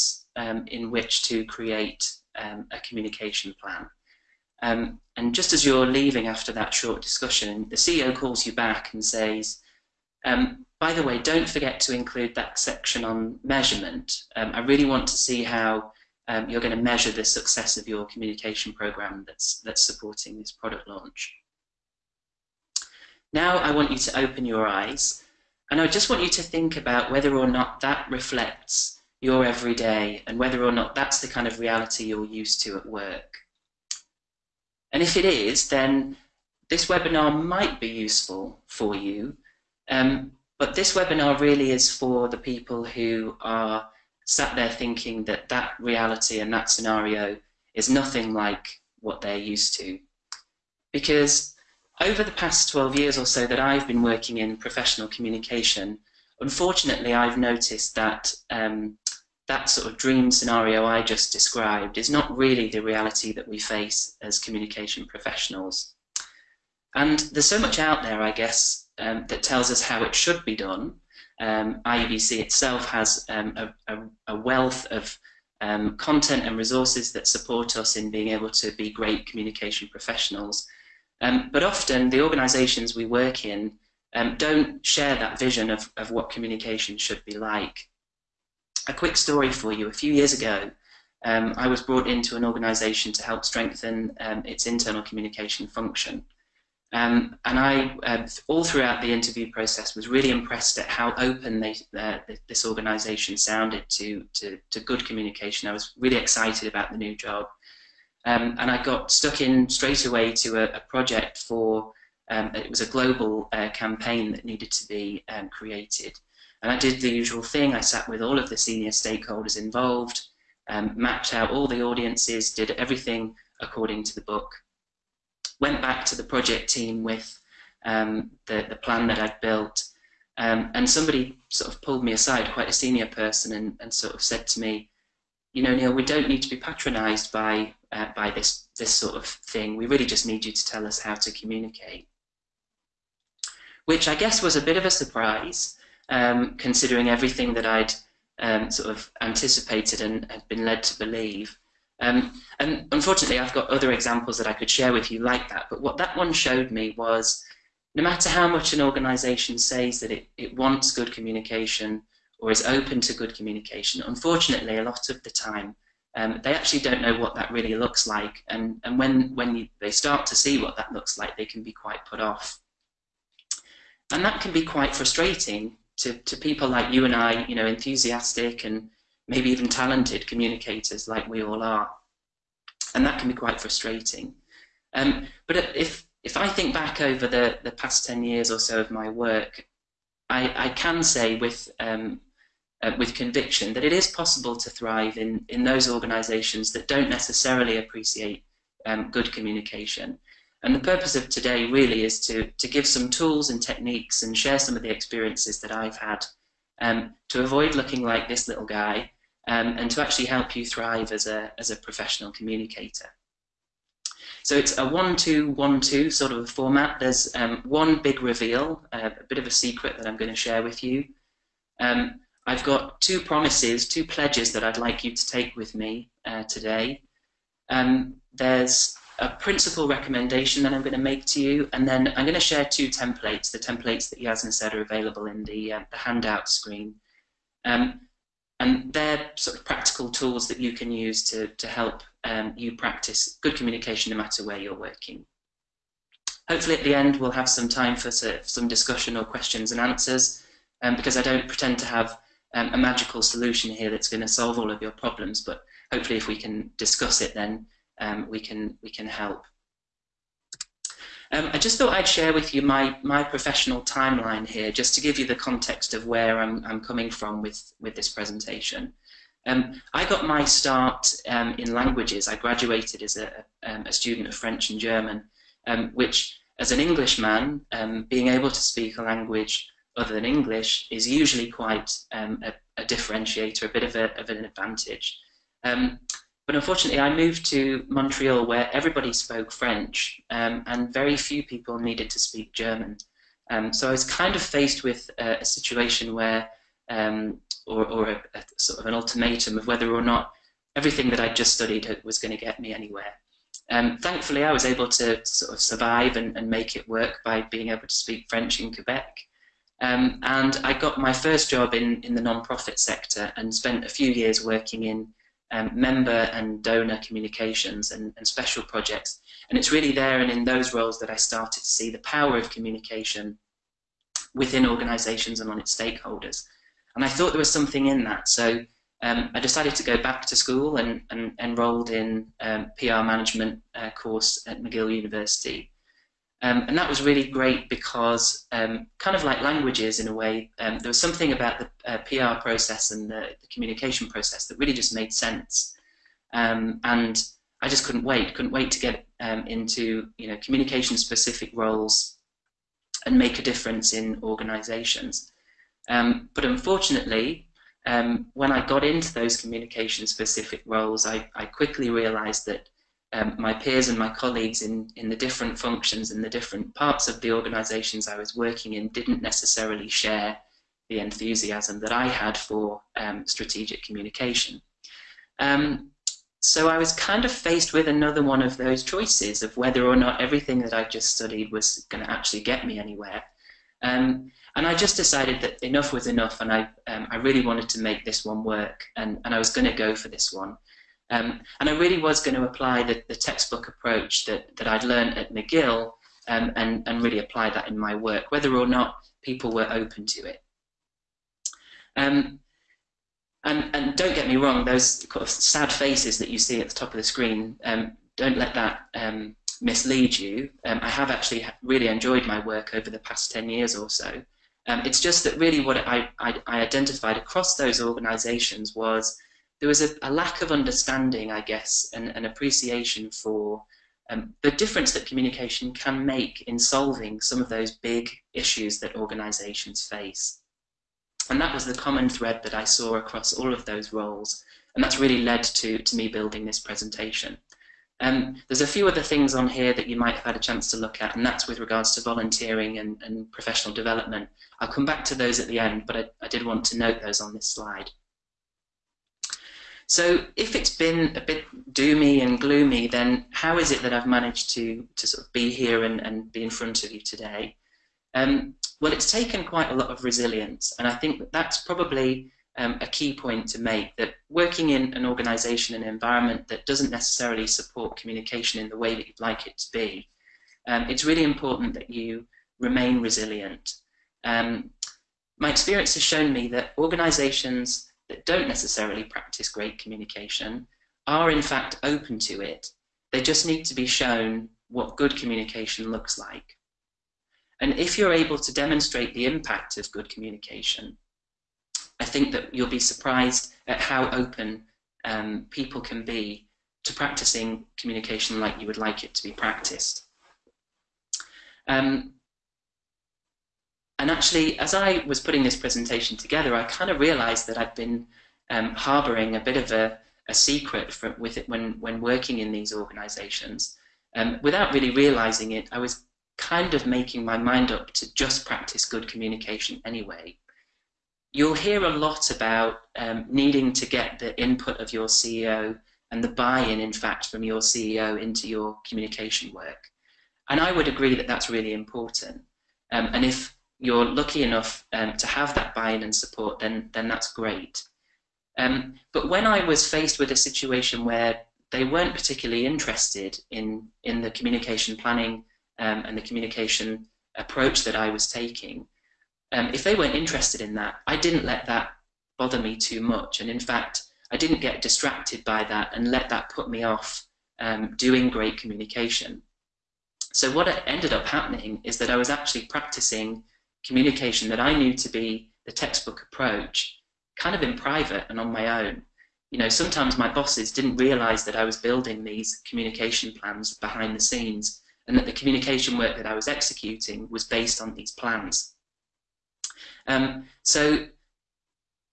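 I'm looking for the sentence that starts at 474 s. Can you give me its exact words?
Um, my experience has shown me that organisations that don't necessarily practice great communication are in fact open to it.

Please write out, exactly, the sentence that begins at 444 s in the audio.
I'll come back to those at the end, but I, I did want to note those on this slide.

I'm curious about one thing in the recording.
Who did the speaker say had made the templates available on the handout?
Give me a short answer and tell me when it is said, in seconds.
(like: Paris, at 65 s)
Yasmin, at 234 s.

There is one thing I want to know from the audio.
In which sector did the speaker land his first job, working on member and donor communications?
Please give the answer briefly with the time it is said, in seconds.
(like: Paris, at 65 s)
non-profit, at 312 s.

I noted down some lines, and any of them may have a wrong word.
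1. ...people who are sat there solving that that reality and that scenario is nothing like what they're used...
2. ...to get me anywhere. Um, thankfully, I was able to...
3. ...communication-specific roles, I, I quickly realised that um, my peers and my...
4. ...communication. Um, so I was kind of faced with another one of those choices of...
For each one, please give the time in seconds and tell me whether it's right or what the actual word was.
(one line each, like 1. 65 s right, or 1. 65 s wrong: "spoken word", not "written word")
1. 42 s wrong: "thinking", not "solving"
2. 302 s right
3. 359 s right
4. 373 s right.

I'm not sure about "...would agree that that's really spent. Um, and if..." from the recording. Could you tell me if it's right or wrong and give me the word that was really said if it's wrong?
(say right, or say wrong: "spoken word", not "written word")
wrong: "important", not "spent".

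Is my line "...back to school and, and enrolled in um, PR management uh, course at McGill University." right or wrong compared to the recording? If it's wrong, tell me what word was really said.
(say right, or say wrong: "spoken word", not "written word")
right.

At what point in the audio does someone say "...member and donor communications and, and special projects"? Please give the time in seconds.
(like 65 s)
315 s.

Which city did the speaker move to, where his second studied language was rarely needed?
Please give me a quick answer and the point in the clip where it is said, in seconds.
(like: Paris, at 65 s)
Montreal, at 287 s.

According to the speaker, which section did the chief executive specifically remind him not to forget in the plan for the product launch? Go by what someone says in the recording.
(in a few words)
measurement.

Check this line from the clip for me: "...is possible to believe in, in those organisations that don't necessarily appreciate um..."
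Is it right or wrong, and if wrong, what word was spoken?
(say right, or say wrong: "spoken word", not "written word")
wrong: "thrive", not "believe".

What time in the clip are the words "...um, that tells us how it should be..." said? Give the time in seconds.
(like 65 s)
68 s.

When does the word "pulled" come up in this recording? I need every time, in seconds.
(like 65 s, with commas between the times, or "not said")
131 s.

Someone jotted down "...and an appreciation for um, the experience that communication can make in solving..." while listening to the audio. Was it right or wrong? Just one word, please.
wrong.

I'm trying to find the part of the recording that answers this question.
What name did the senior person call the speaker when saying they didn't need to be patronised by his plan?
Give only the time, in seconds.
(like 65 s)
135 s.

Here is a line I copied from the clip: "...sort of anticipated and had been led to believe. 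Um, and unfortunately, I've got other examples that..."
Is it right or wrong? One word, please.
right.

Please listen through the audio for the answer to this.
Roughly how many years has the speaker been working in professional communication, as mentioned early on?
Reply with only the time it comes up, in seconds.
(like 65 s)
52 s.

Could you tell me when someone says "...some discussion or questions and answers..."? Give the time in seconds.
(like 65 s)
248 s.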